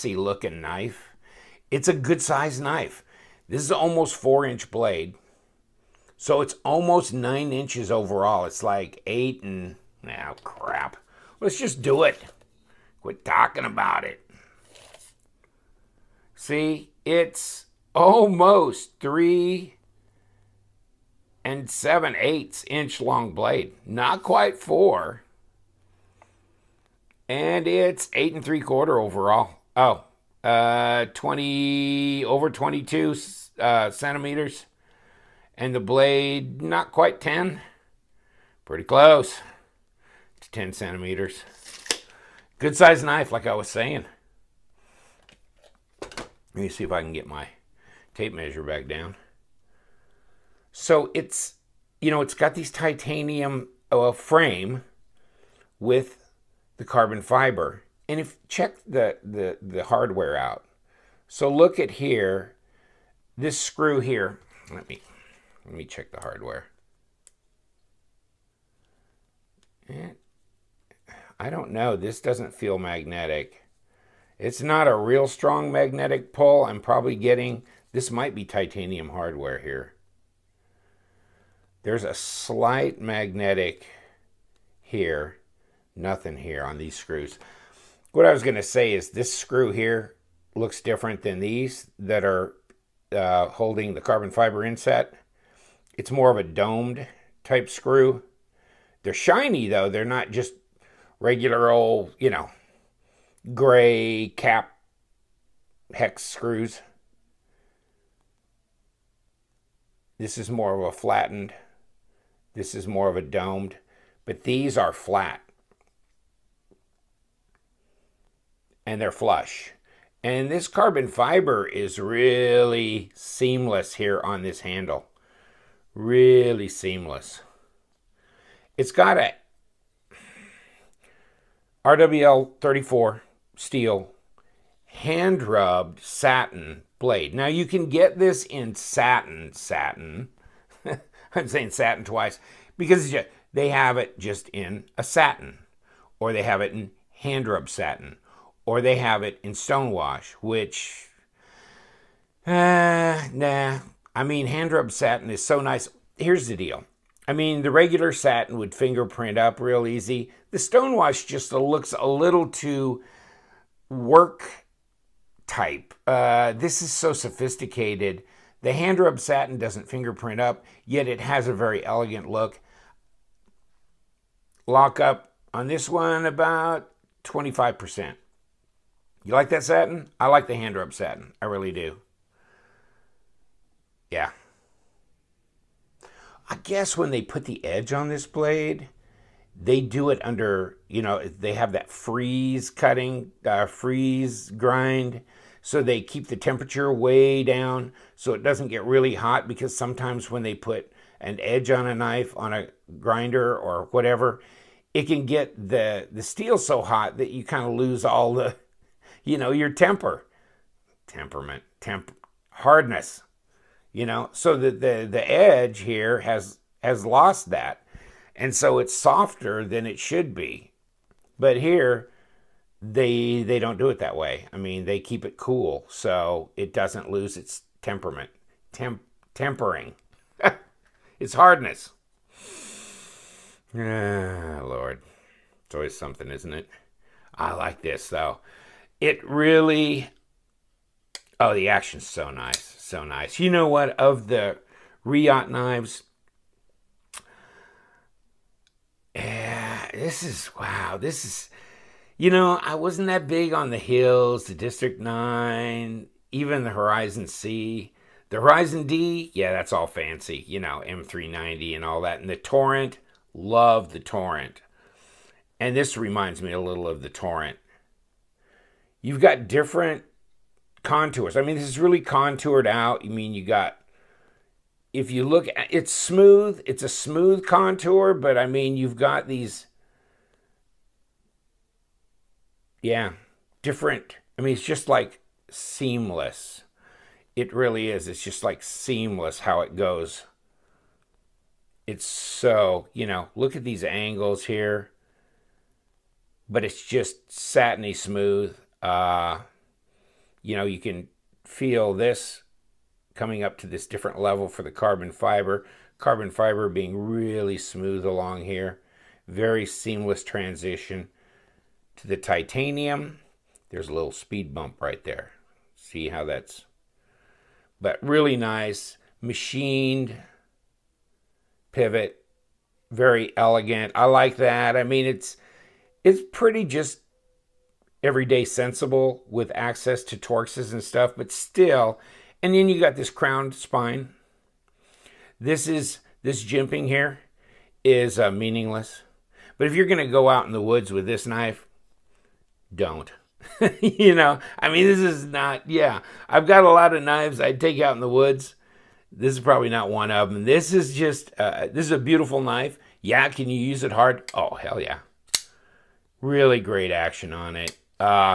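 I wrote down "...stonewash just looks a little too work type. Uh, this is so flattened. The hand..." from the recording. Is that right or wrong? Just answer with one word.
wrong.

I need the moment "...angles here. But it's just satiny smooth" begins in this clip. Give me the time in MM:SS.
04:53.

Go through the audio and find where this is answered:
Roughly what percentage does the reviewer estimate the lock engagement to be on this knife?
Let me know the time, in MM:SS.
02:56.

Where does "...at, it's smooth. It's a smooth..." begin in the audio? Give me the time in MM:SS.
04:35.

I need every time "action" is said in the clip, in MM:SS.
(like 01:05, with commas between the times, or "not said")
04:01, 05:56.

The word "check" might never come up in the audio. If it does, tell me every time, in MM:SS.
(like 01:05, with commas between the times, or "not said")
00:58, 01:05.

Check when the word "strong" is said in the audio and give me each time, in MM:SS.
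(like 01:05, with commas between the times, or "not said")
01:15.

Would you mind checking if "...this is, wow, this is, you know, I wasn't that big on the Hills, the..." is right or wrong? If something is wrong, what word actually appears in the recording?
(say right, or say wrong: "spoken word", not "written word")
right.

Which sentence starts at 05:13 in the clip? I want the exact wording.
There's a little speed bump right there.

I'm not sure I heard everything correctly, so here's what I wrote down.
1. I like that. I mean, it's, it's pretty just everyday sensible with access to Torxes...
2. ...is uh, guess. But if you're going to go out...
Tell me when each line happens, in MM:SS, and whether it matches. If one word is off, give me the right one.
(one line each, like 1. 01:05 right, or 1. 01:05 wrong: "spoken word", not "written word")
1. 05:23 right
2. 05:37 wrong: "meaningless", not "guess".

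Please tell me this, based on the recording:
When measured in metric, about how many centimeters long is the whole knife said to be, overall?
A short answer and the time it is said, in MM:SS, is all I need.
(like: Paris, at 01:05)
22 centimeters, at 00:32.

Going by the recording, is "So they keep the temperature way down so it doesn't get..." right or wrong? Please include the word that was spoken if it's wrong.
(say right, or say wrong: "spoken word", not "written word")
right.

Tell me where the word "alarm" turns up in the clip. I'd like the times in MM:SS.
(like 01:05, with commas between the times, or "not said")
not said.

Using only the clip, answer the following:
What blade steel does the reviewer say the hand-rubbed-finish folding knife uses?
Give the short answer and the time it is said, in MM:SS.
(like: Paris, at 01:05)
RWL34, at 02:11.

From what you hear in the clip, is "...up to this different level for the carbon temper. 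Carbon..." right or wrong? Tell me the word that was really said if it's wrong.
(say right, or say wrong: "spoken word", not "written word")
wrong: "fiber", not "temper".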